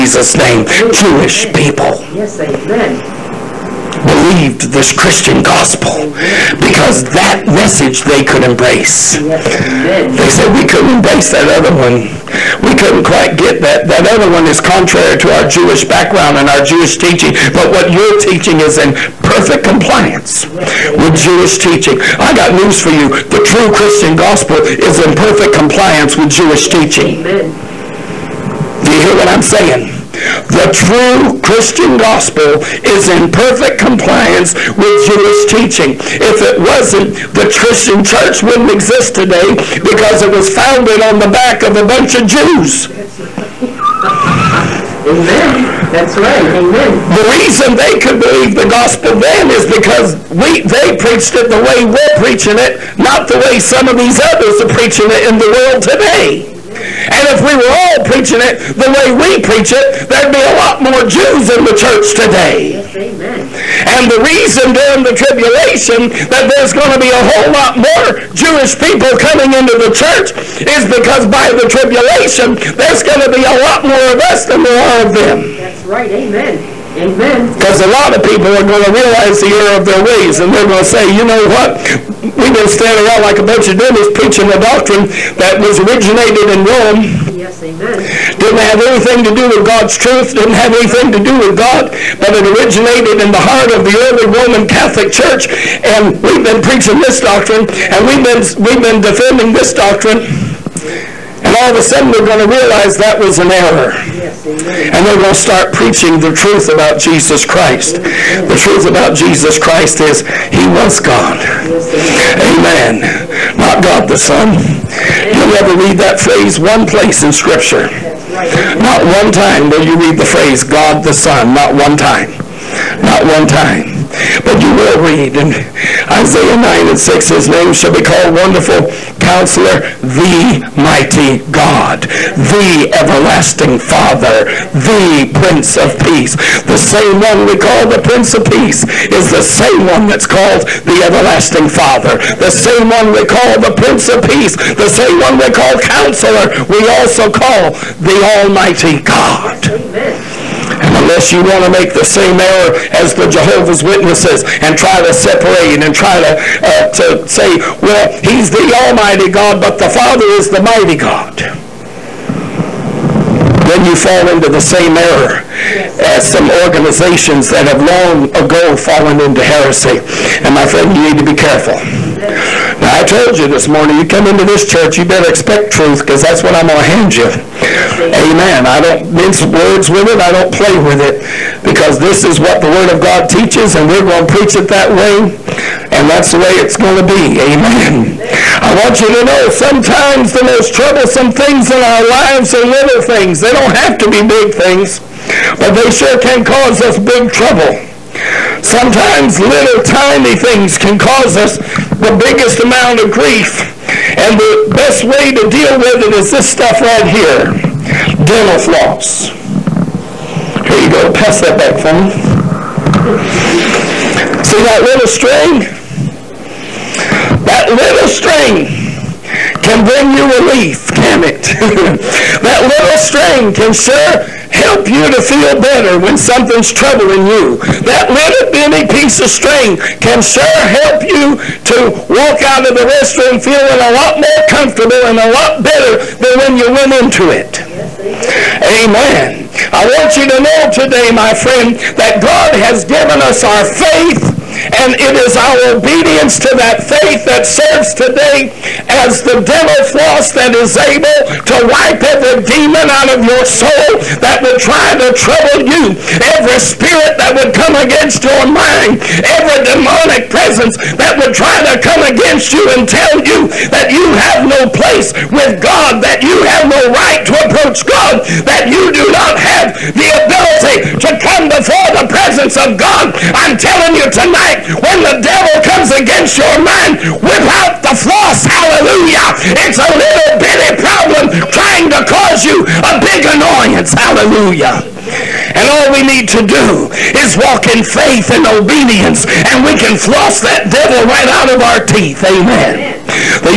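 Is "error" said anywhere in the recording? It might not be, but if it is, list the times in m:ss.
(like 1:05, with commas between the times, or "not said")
1:19, 1:43, 2:32, 2:44.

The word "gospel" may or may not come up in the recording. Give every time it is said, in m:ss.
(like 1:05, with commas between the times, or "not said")
0:05, 0:24, 0:32, 0:48.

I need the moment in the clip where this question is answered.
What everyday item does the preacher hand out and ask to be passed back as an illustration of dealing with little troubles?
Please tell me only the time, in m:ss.
3:28.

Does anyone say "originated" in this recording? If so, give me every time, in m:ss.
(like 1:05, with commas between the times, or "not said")
1:25, 1:32.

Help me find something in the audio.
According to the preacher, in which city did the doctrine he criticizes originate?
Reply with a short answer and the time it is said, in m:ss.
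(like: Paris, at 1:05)
Rome, at 1:26.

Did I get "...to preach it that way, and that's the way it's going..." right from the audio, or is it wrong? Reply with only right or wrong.
right.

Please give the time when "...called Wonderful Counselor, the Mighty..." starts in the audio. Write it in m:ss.
2:08.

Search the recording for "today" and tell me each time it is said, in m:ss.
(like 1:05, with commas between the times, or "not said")
0:39, 0:55, 1:02, 4:00, 4:07.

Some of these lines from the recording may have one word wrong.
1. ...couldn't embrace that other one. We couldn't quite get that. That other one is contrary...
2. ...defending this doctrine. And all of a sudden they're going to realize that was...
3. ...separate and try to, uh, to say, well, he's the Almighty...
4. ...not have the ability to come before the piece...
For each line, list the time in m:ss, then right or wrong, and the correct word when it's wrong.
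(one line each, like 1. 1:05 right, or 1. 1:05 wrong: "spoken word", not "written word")
1. 0:10 right
2. 1:39 right
3. 2:35 right
4. 4:29 wrong: "presence", not "piece".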